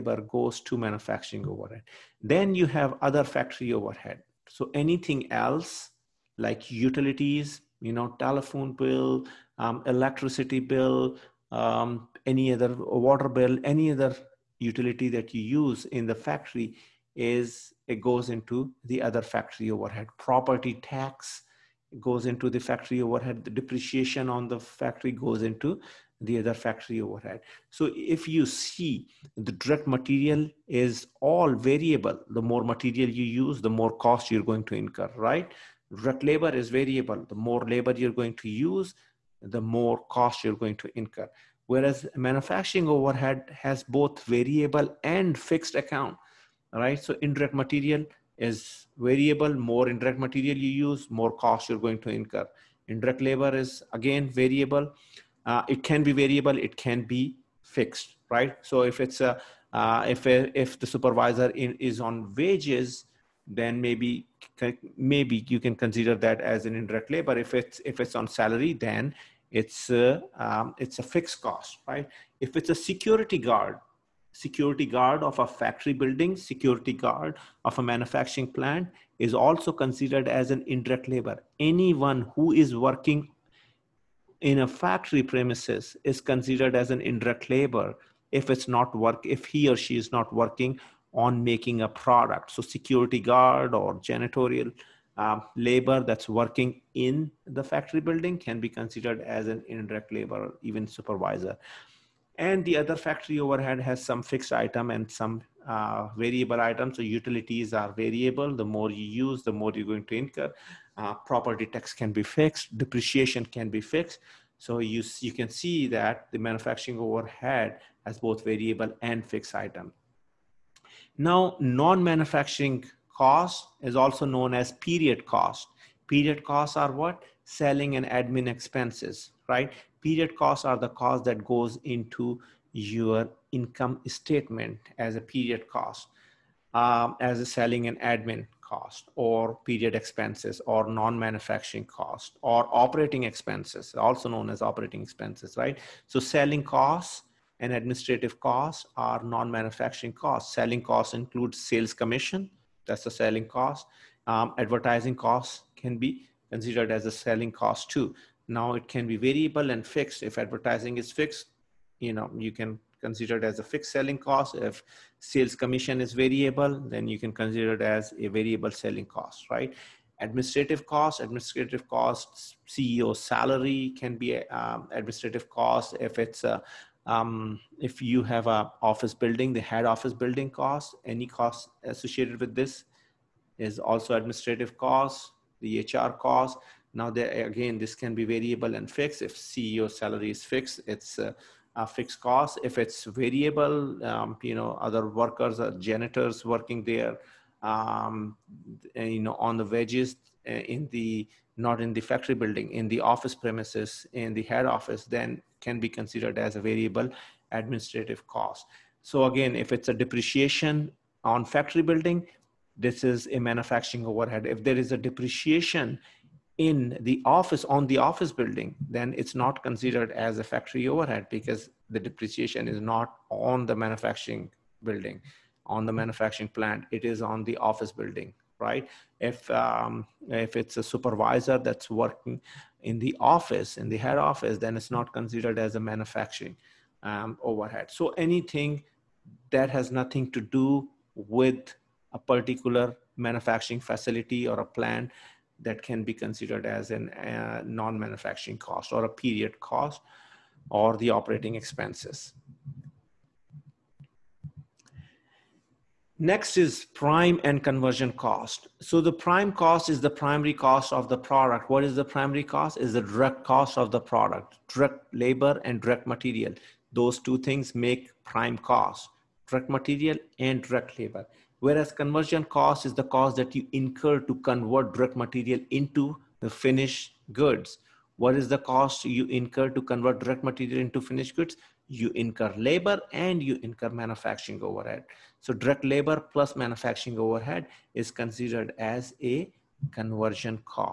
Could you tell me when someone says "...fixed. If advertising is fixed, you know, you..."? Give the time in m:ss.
2:39.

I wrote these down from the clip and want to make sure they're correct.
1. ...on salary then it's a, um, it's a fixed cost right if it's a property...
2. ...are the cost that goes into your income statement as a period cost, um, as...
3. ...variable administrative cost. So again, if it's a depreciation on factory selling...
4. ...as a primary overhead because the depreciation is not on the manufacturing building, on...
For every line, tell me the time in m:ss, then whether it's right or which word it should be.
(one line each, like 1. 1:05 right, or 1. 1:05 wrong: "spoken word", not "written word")
1. 1:08 wrong: "security", not "property"
2. 2:10 right
3. 3:26 wrong: "building", not "selling"
4. 3:40 wrong: "factory", not "primary".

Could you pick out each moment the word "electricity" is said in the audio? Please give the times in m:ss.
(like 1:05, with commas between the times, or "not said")
0:09.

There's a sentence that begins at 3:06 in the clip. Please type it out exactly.
Now, there, again, this can be variable and fixed.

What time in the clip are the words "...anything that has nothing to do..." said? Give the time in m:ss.
3:58.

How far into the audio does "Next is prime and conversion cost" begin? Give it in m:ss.
4:16.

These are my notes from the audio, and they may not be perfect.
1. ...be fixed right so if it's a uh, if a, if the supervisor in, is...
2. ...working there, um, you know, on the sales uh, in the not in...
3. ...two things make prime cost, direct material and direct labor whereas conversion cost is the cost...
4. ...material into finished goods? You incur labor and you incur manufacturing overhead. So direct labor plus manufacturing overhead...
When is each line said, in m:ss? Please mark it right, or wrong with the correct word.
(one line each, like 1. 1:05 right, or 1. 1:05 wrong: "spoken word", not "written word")
1. 0:57 right
2. 3:16 wrong: "wages", not "sales"
3. 4:27 right
4. 4:40 right.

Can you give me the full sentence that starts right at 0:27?
So if you see the direct material is all variable.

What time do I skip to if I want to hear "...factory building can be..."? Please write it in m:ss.
1:37.